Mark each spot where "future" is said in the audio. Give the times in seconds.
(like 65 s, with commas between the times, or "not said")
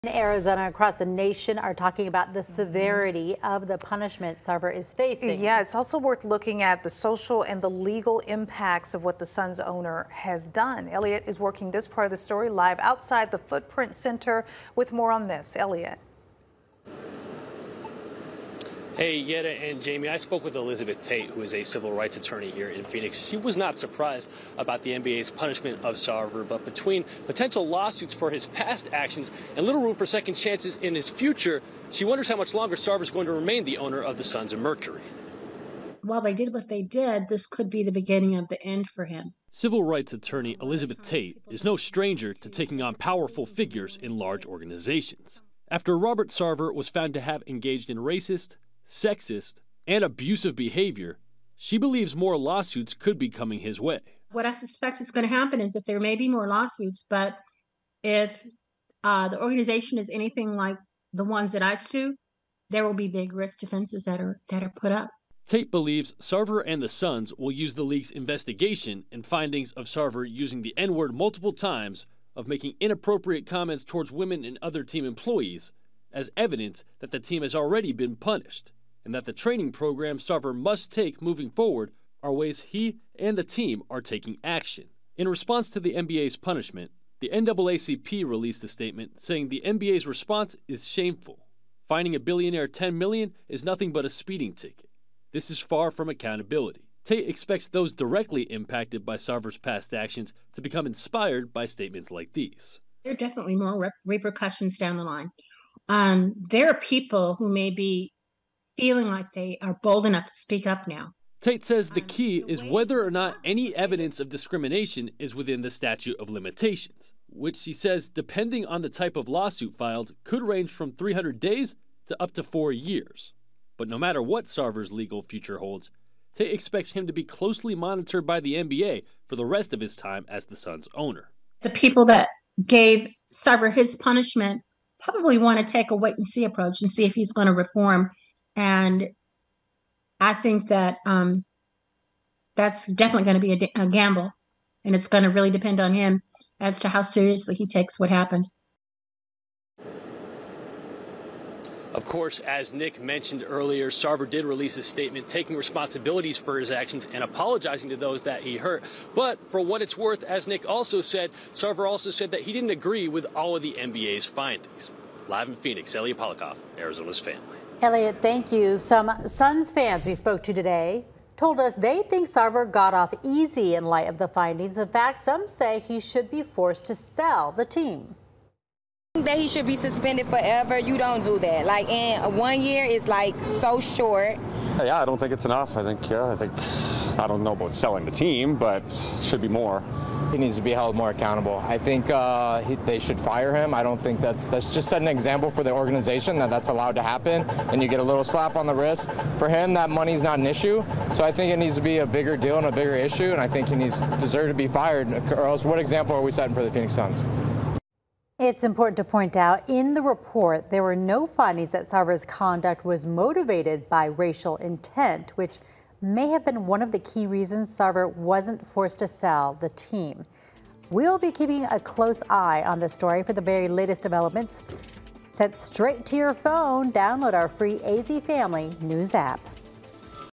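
31 s, 125 s.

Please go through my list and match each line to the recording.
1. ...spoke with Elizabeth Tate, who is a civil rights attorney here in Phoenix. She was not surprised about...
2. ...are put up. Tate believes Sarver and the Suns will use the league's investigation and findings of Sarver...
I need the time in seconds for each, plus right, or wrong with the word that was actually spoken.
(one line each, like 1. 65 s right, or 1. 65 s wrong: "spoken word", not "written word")
1. 20 s right
2. 64 s right.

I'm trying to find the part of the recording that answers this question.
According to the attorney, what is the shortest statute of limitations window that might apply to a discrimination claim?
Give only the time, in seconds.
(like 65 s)
120 s.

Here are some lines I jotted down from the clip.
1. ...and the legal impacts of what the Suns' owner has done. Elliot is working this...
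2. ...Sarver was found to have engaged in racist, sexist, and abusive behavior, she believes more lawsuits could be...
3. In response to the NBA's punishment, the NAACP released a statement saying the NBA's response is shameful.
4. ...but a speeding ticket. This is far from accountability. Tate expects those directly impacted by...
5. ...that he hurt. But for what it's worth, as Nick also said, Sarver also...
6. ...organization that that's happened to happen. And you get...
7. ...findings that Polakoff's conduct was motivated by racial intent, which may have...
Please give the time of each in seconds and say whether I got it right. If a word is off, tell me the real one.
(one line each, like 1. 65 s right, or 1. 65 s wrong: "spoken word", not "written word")
1. 7 s right
2. 46 s right
3. 85 s right
4. 93 s right
5. 158 s right
6. 195 s wrong: "allowed", not "happened"
7. 211 s wrong: "Sarver", not "Polakoff".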